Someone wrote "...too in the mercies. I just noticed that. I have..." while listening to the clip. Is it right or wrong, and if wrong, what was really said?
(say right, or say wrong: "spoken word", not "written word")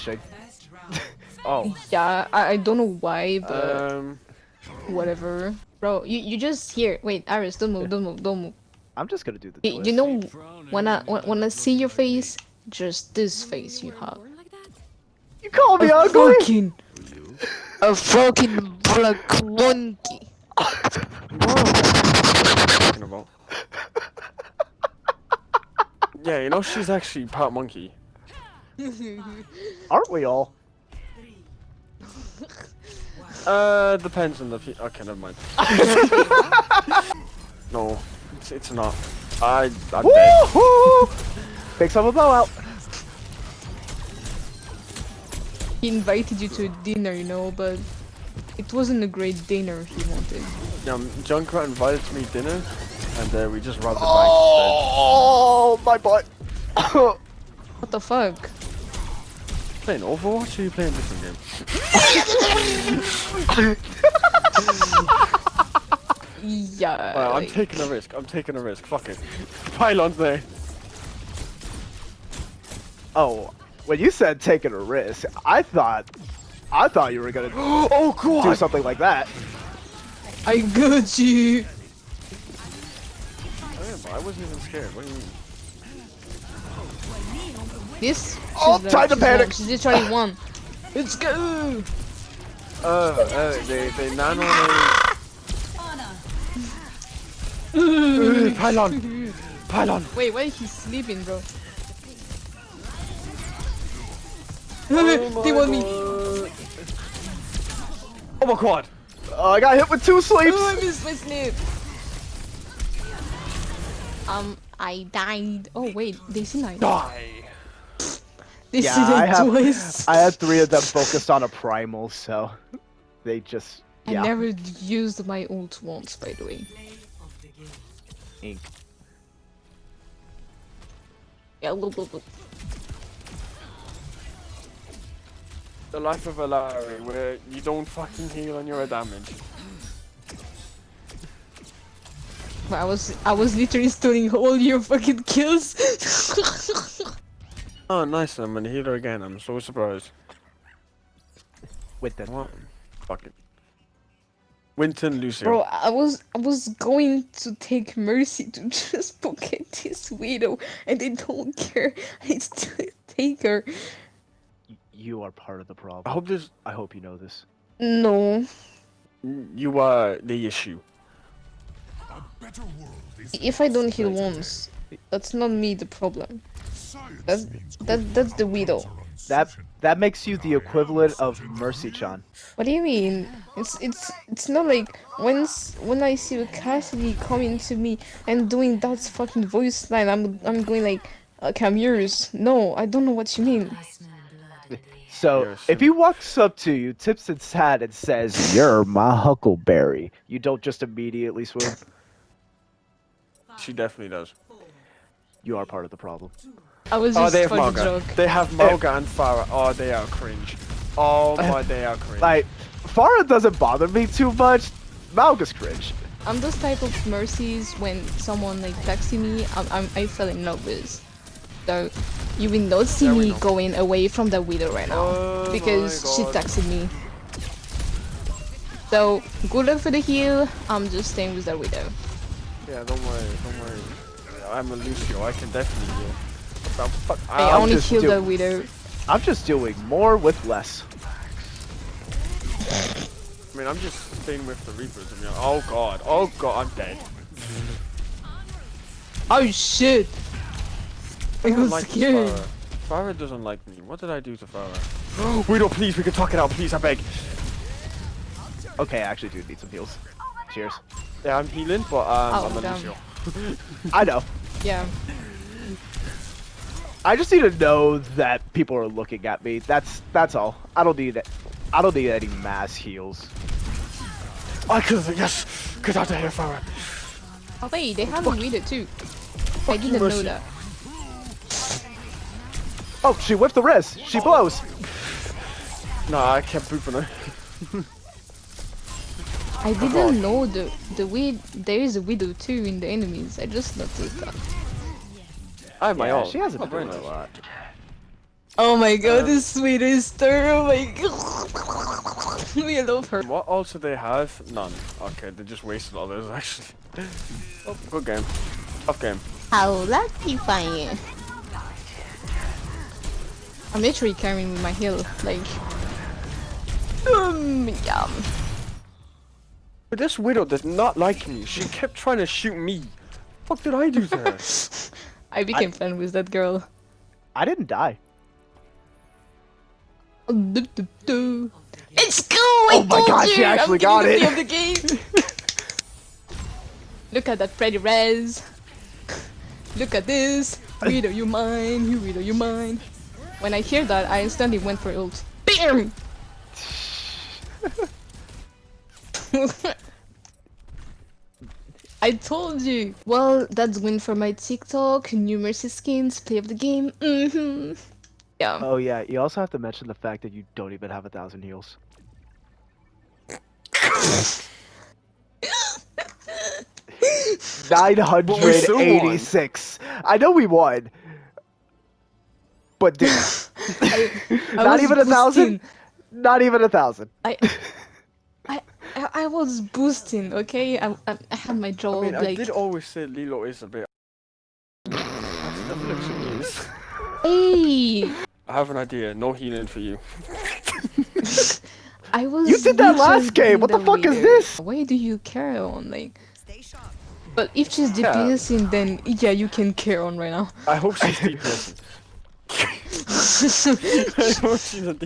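wrong: "enemies", not "mercies".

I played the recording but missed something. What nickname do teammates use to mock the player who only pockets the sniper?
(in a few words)
Mercy Chan.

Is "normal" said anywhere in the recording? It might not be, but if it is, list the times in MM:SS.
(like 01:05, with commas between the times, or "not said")
not said.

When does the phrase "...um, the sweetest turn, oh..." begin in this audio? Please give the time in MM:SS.
04:59.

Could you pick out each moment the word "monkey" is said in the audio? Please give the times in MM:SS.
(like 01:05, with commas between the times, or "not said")
00:19, 00:27.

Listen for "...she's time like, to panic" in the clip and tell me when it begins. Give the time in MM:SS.
01:28.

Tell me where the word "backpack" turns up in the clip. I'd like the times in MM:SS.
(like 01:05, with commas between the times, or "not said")
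not said.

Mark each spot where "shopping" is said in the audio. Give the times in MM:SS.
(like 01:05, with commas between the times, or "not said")
not said.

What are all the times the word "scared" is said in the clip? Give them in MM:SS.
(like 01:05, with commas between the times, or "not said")
01:24, 04:11.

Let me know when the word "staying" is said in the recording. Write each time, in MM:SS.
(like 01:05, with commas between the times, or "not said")
03:51, 04:04.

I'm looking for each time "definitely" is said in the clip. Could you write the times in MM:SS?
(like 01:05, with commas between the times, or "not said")
03:23, 03:55.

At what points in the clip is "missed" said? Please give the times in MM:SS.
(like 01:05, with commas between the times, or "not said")
01:50.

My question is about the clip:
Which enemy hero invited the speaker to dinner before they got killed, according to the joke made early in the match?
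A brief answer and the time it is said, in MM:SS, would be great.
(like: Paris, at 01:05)
Junkrat, at 00:51.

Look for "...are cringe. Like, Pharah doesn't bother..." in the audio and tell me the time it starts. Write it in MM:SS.
03:31.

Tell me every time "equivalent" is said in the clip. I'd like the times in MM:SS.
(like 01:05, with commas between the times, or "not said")
03:00.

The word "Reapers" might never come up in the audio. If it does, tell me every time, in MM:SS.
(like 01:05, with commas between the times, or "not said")
04:04.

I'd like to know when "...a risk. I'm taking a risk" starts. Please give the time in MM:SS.
01:07.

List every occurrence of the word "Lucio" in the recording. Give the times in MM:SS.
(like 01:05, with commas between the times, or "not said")
02:35, 03:54.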